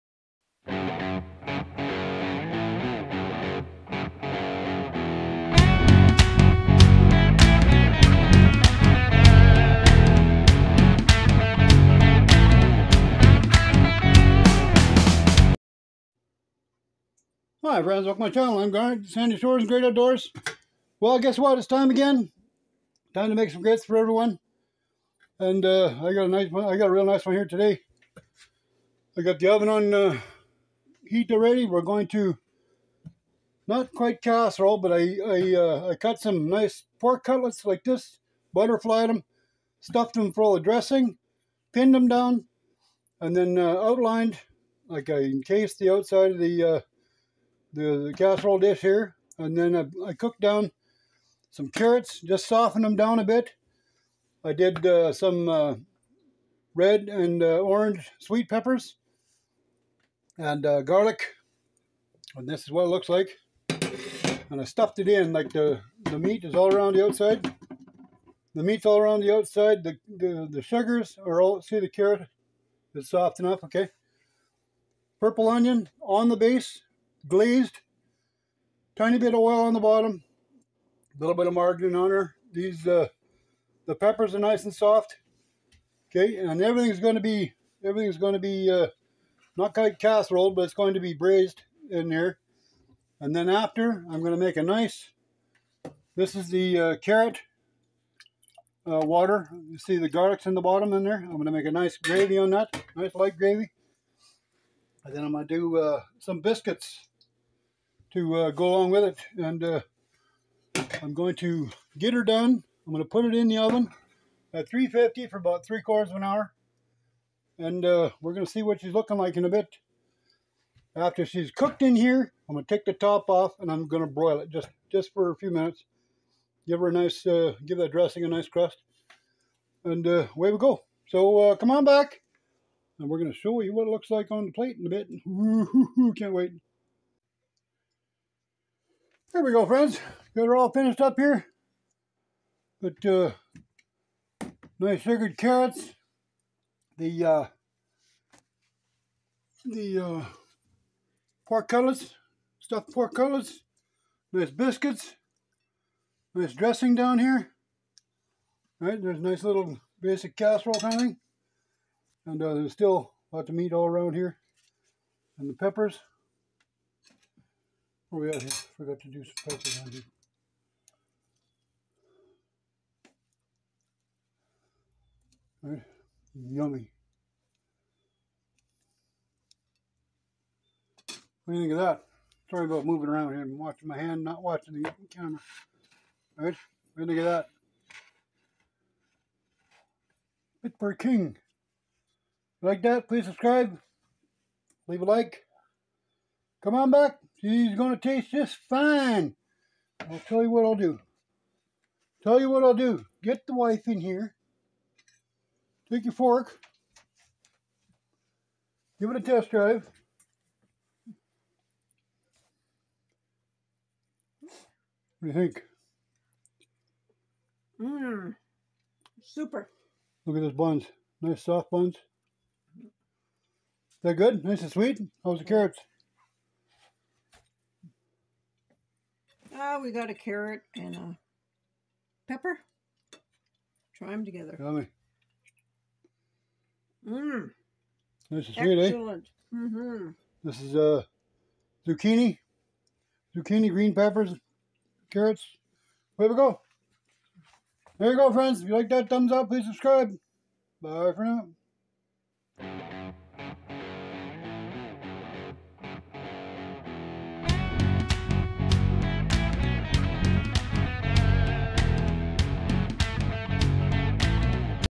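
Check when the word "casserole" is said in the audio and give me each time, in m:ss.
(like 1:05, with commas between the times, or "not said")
0:34, 0:48, 1:29, 2:40.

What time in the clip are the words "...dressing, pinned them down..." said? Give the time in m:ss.
0:40.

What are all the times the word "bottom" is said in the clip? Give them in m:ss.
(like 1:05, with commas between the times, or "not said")
1:19, 1:40.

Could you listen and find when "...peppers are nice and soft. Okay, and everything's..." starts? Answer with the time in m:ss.
1:23.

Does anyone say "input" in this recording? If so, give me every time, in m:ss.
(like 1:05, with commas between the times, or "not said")
not said.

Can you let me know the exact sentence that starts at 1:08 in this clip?
The meat's all around the outside.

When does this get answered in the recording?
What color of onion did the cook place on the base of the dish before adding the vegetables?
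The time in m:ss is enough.
1:15.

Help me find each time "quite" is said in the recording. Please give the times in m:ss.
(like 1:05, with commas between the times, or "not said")
0:33, 1:29.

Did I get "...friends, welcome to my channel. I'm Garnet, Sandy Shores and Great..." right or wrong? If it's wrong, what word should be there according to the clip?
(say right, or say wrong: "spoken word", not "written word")
right.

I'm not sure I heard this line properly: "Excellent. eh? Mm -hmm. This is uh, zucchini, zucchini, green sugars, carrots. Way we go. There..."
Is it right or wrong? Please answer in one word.
wrong.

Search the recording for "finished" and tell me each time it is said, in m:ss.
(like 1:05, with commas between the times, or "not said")
2:20.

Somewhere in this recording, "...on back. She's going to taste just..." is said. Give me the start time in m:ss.
3:16.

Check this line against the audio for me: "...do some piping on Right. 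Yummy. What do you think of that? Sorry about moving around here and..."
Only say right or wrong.
right.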